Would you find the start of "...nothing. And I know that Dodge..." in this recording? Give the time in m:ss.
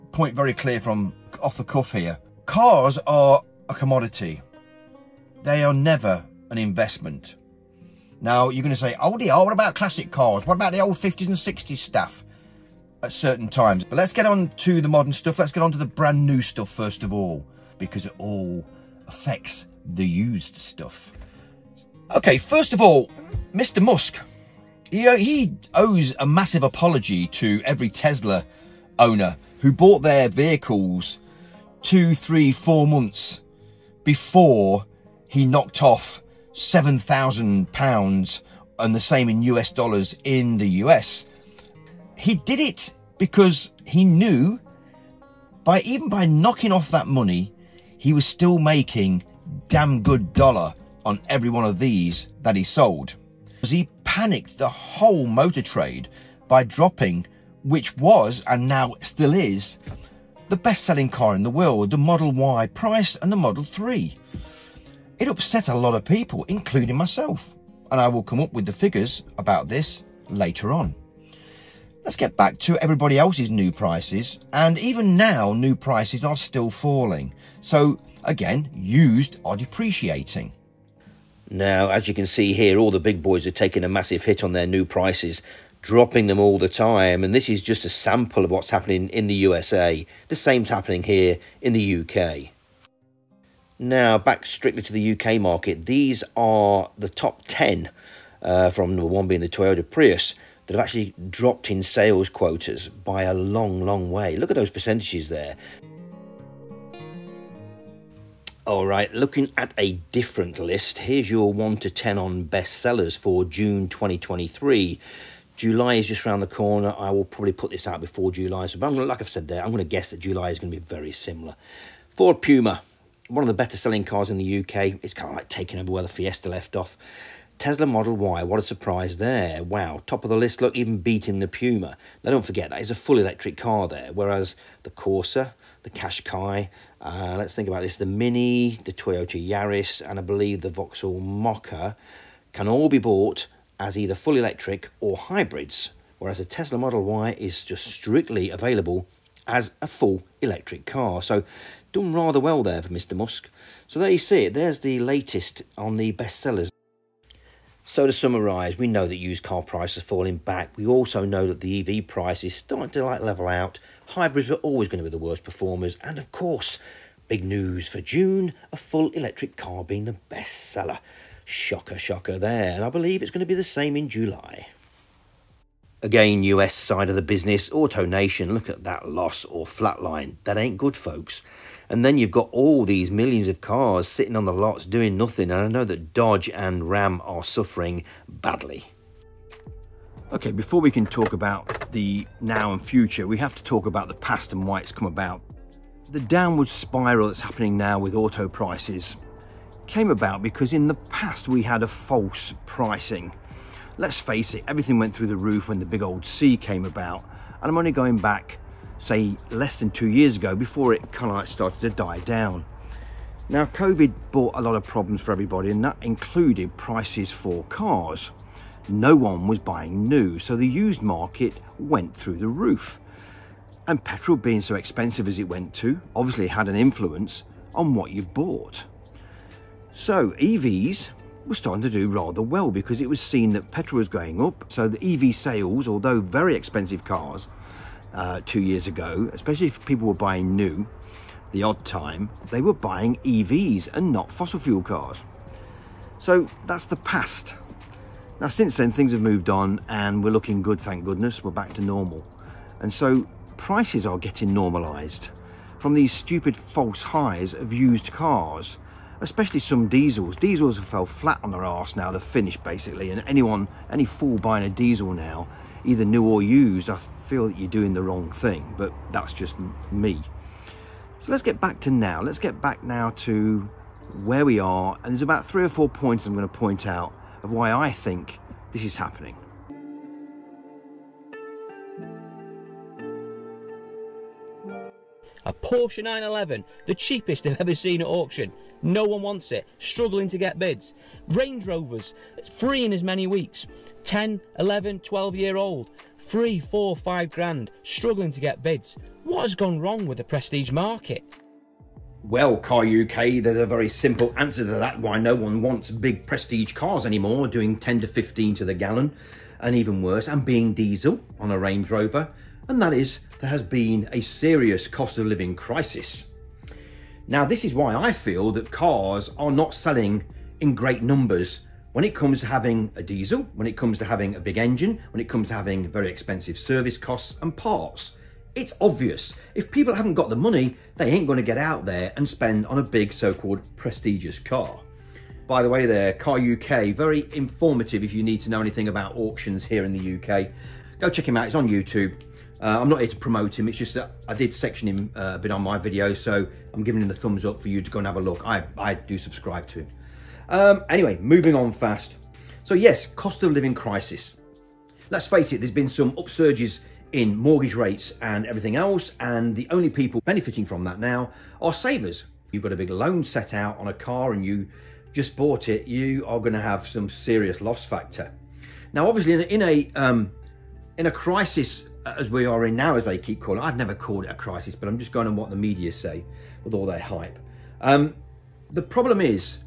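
3:05.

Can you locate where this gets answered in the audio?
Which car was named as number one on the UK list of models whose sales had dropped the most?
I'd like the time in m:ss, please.
1:39.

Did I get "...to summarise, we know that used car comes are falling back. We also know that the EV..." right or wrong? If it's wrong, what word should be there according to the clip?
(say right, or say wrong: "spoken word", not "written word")
wrong: "prices", not "comes".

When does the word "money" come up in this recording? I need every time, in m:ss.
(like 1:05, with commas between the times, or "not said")
0:47, 5:30.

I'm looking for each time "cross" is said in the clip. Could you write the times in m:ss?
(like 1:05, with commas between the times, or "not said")
not said.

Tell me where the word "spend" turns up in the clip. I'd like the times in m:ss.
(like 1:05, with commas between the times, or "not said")
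5:32.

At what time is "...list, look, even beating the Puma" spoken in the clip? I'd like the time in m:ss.
2:10.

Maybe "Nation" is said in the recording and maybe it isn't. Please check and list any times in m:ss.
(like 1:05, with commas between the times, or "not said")
2:58.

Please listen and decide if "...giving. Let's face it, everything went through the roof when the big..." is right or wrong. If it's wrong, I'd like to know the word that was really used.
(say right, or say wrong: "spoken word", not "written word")
wrong: "pricing", not "giving".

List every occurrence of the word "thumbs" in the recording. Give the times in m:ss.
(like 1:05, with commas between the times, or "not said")
5:47.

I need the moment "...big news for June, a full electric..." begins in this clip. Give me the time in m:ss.
2:47.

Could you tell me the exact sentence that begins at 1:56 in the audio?
I will probably put this out before July.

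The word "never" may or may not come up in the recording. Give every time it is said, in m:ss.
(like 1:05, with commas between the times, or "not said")
0:05, 6:13.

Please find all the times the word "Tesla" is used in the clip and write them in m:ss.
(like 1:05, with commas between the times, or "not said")
0:27, 2:07, 2:26.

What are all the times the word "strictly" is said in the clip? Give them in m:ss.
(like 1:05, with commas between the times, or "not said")
1:34, 2:27.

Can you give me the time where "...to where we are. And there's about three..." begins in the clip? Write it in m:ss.
4:33.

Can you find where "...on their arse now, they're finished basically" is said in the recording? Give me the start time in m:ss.
4:21.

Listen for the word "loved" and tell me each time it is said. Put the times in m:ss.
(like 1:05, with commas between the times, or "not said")
not said.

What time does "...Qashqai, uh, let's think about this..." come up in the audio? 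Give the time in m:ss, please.
2:15.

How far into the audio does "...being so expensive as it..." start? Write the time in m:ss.
3:44.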